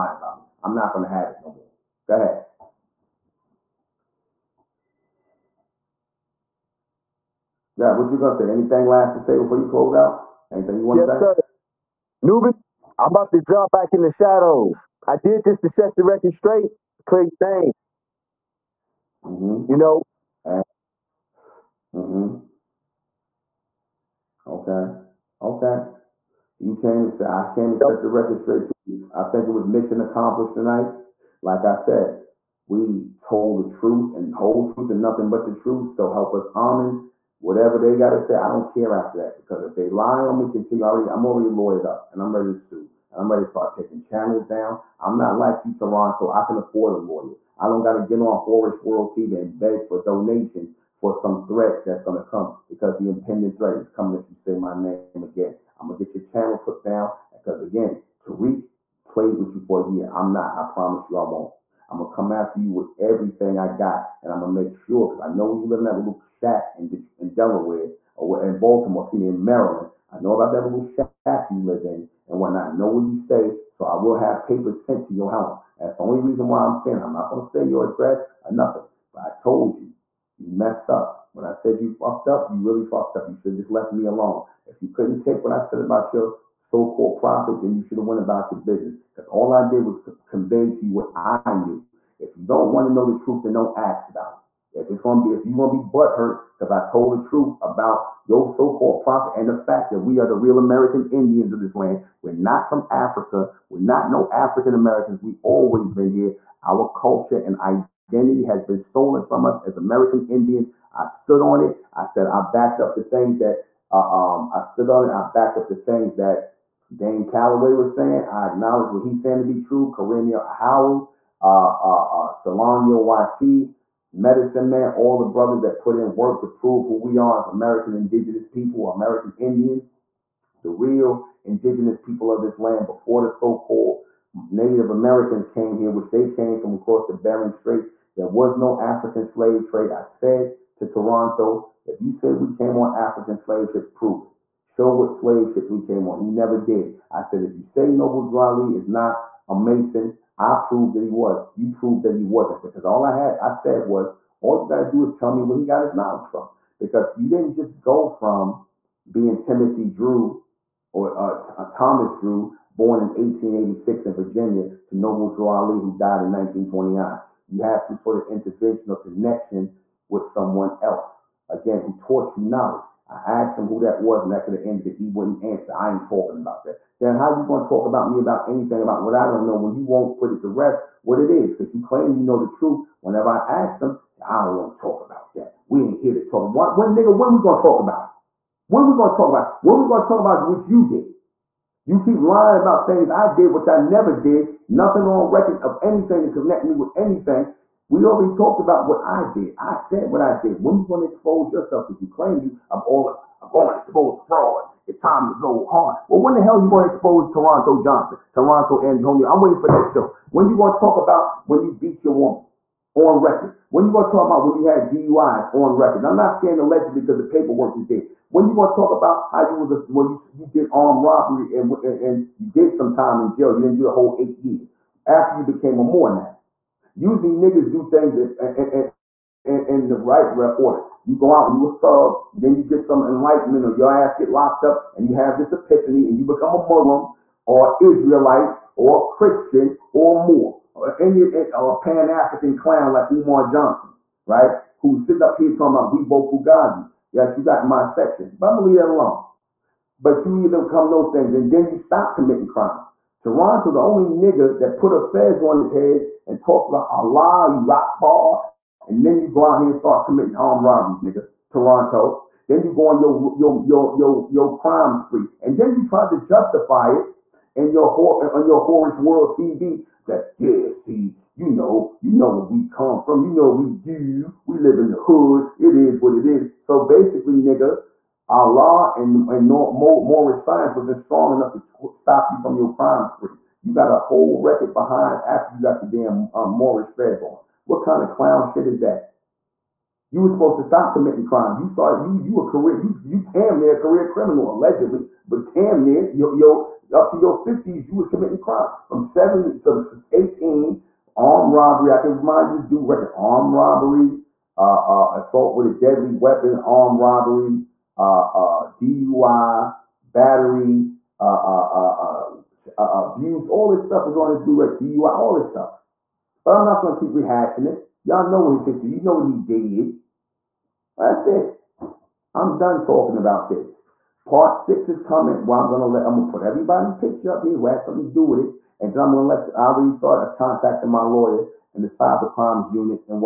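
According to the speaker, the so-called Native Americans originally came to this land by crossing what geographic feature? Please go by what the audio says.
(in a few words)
Bering Straits.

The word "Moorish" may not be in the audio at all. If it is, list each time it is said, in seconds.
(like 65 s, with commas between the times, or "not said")
279 s, 286 s.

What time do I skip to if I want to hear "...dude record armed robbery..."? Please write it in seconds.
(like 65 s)
302 s.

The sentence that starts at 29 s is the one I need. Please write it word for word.
I think it was mission accomplished tonight.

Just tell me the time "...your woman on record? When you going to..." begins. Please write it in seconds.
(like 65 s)
212 s.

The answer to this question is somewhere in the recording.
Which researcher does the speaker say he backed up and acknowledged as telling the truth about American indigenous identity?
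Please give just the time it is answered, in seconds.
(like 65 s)
116 s.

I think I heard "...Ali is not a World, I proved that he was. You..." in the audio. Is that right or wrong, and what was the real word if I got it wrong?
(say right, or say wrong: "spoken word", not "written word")
wrong: "Mason", not "World".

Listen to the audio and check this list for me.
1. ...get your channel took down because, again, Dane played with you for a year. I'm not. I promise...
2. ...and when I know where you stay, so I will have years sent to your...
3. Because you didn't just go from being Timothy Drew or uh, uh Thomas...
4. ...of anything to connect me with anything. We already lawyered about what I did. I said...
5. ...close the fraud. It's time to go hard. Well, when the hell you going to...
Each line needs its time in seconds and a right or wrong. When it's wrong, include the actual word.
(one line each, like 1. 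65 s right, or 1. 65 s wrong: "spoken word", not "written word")
1. 56 s wrong: "Tariq", not "Dane"
2. 72 s wrong: "papers", not "years"
3. 156 s right
4. 195 s wrong: "talked", not "lawyered"
5. 203 s wrong: "expose", not "close".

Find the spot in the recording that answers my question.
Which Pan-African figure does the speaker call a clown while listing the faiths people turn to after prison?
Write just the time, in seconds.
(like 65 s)
243 s.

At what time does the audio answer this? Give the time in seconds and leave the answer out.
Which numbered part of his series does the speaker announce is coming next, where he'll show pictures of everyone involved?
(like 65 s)
324 s.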